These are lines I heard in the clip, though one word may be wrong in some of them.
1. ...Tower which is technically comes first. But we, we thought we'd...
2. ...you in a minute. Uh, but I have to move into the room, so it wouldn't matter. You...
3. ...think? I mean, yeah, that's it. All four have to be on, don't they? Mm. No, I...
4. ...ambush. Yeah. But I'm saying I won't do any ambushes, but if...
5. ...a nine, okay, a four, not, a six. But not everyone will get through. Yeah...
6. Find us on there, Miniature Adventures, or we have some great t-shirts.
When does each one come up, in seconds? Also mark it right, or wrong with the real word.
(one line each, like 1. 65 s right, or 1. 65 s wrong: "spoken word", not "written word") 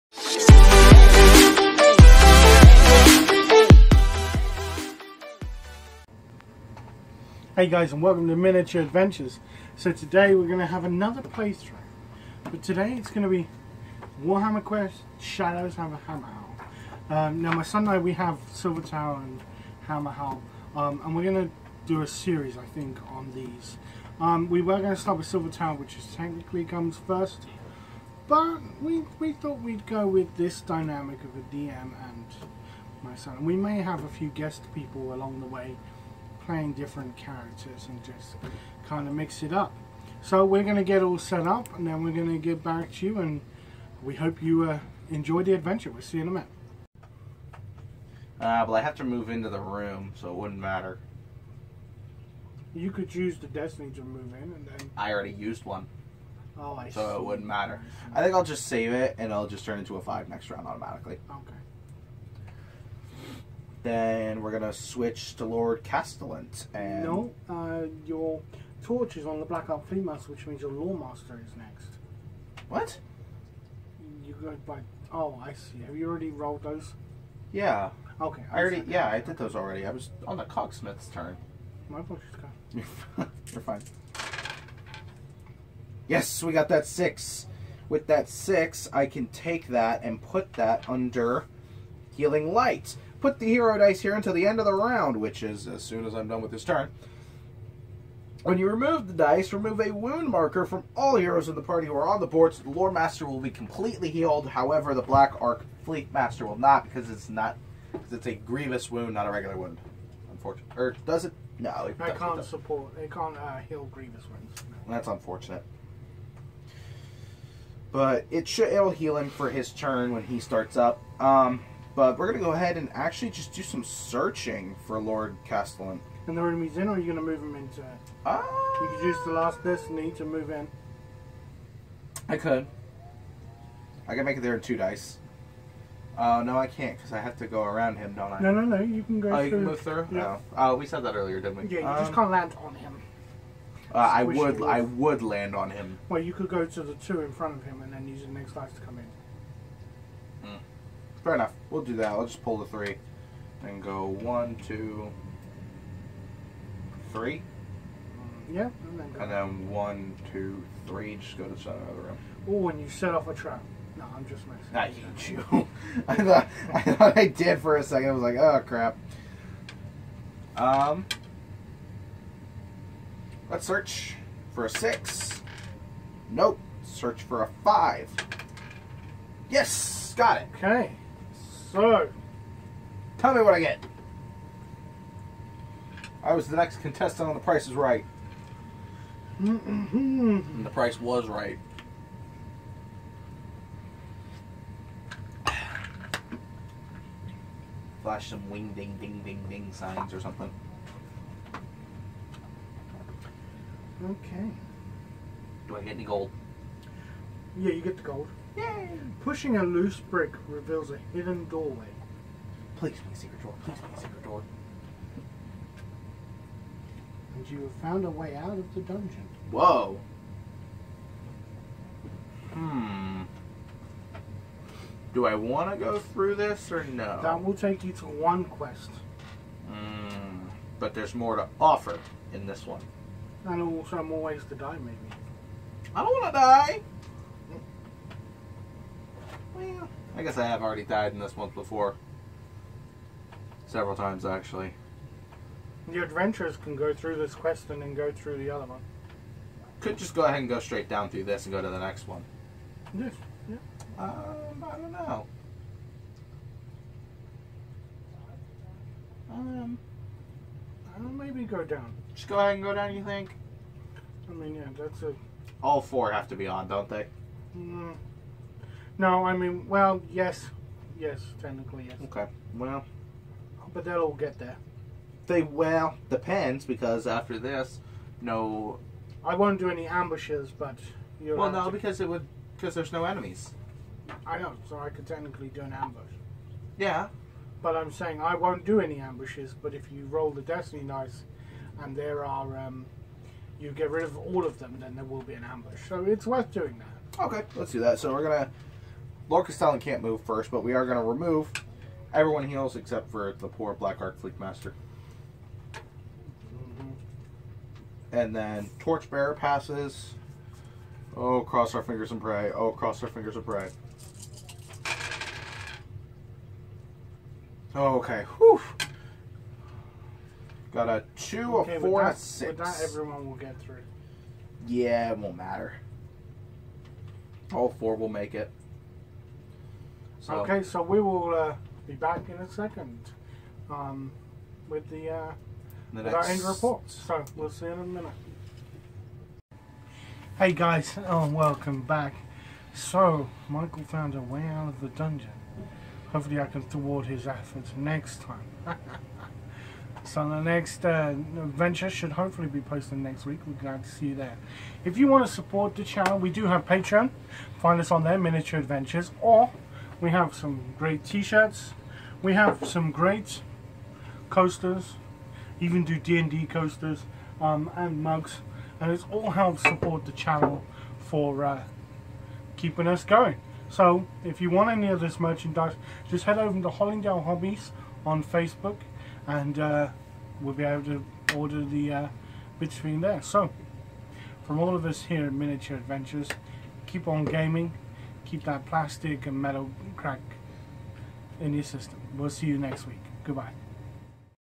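1. 25 s right
2. 46 s right
3. 263 s right
4. 285 s right
5. 320 s wrong: "two", not "nine"
6. 357 s right.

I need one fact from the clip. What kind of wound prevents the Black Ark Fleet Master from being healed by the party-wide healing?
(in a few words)
Grievous wound.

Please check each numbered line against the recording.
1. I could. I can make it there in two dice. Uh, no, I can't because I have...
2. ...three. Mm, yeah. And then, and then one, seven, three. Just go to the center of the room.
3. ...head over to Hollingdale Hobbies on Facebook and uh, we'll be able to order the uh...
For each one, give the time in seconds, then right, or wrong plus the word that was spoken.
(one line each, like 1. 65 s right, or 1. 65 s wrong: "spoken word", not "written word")
1. 132 s right
2. 157 s wrong: "two", not "seven"
3. 376 s right.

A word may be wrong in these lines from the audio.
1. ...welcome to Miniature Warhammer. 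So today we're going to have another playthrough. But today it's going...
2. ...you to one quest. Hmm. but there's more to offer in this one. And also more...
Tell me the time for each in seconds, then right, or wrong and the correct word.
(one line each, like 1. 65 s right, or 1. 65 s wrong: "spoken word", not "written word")
1. 8 s wrong: "Adventures", not "Warhammer"
2. 227 s right.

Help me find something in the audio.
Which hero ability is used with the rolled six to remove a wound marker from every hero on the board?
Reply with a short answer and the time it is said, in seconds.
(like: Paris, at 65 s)
Healing Light, at 92 s.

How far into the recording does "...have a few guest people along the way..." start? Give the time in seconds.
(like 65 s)
33 s.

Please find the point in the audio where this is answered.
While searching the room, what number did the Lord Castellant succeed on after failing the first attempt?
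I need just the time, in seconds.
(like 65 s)
176 s.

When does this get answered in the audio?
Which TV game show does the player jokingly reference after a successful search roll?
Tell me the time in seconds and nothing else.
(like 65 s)
187 s.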